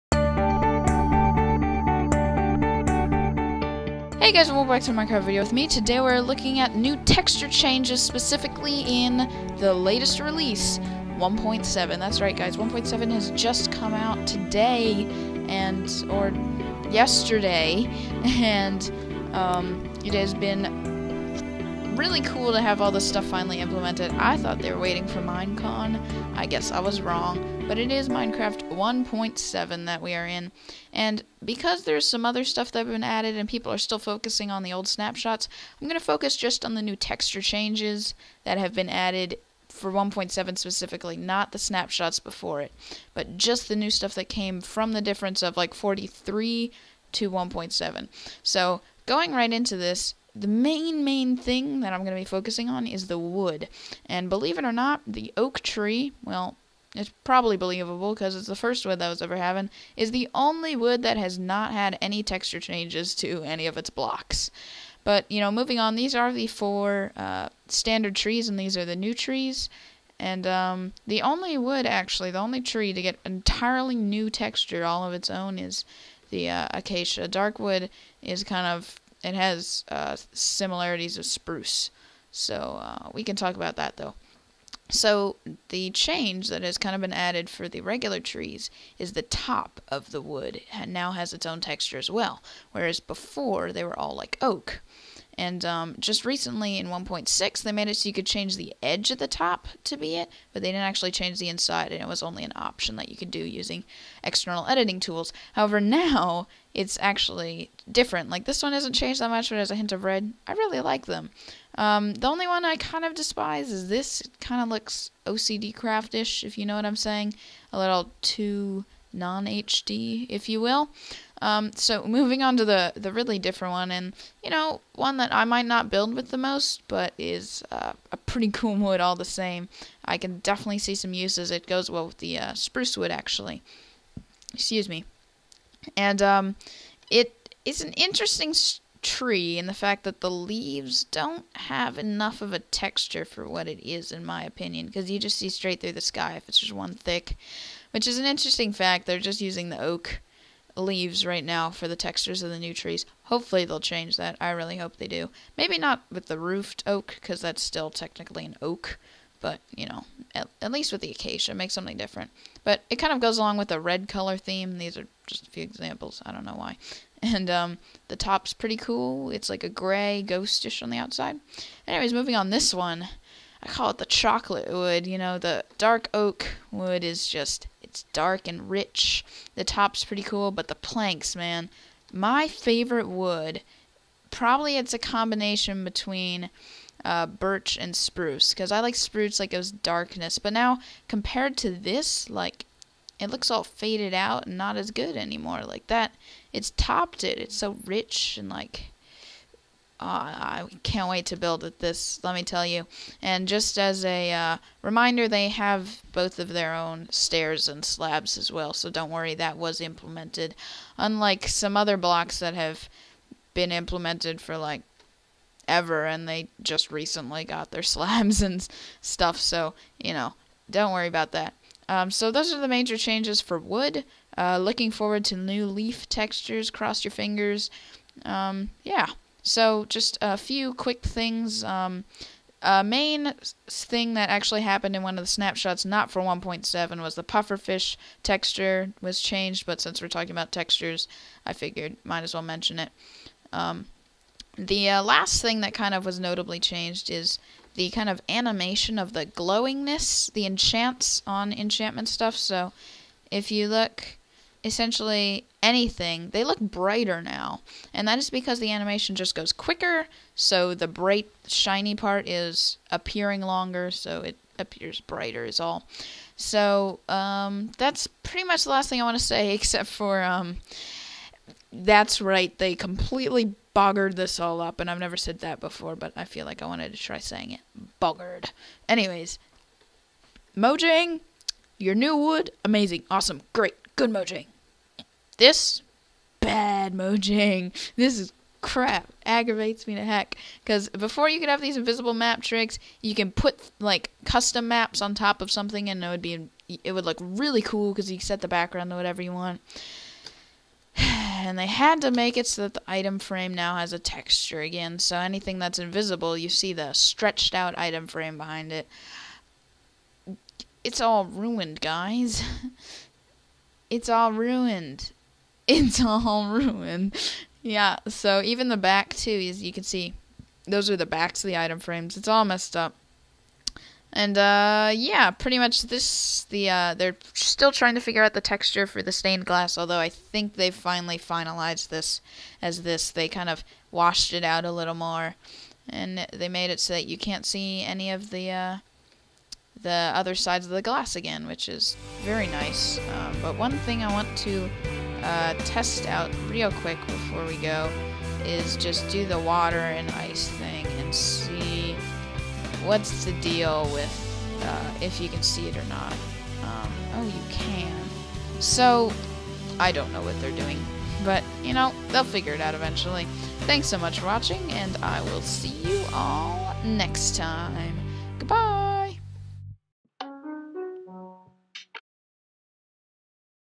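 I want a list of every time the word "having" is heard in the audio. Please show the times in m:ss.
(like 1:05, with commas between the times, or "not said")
0:59.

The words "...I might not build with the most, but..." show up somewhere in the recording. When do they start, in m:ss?
2:05.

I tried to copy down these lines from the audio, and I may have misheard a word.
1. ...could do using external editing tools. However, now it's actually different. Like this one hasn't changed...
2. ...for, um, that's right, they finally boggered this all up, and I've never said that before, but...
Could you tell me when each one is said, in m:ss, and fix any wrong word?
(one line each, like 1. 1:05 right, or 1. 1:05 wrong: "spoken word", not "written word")
1. 1:43 right
2. 4:29 wrong: "completely", not "finally".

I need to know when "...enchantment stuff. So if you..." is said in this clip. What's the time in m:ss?
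4:11.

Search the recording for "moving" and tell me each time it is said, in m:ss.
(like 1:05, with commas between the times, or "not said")
1:05, 2:02, 2:52.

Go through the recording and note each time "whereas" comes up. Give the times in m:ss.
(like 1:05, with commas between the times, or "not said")
1:32.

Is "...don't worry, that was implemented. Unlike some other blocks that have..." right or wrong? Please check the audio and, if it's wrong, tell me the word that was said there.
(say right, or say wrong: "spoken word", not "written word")
right.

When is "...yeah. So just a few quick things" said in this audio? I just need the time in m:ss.
3:48.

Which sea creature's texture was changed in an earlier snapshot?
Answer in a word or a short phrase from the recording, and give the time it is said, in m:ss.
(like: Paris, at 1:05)
Pufferfish, at 3:57.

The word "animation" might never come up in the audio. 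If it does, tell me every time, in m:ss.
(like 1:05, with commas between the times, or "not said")
4:08, 4:18.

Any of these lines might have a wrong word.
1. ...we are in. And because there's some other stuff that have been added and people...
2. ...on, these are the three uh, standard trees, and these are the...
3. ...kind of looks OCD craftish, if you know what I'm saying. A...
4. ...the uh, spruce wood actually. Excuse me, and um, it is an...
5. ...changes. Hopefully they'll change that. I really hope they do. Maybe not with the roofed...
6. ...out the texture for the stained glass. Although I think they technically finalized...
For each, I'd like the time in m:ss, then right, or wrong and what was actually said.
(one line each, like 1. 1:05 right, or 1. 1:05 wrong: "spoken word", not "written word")
1. 0:30 right
2. 1:05 wrong: "four", not "three"
3. 1:54 right
4. 2:12 right
5. 2:32 wrong: "trees", not "changes"
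6. 5:28 wrong: "finally", not "technically".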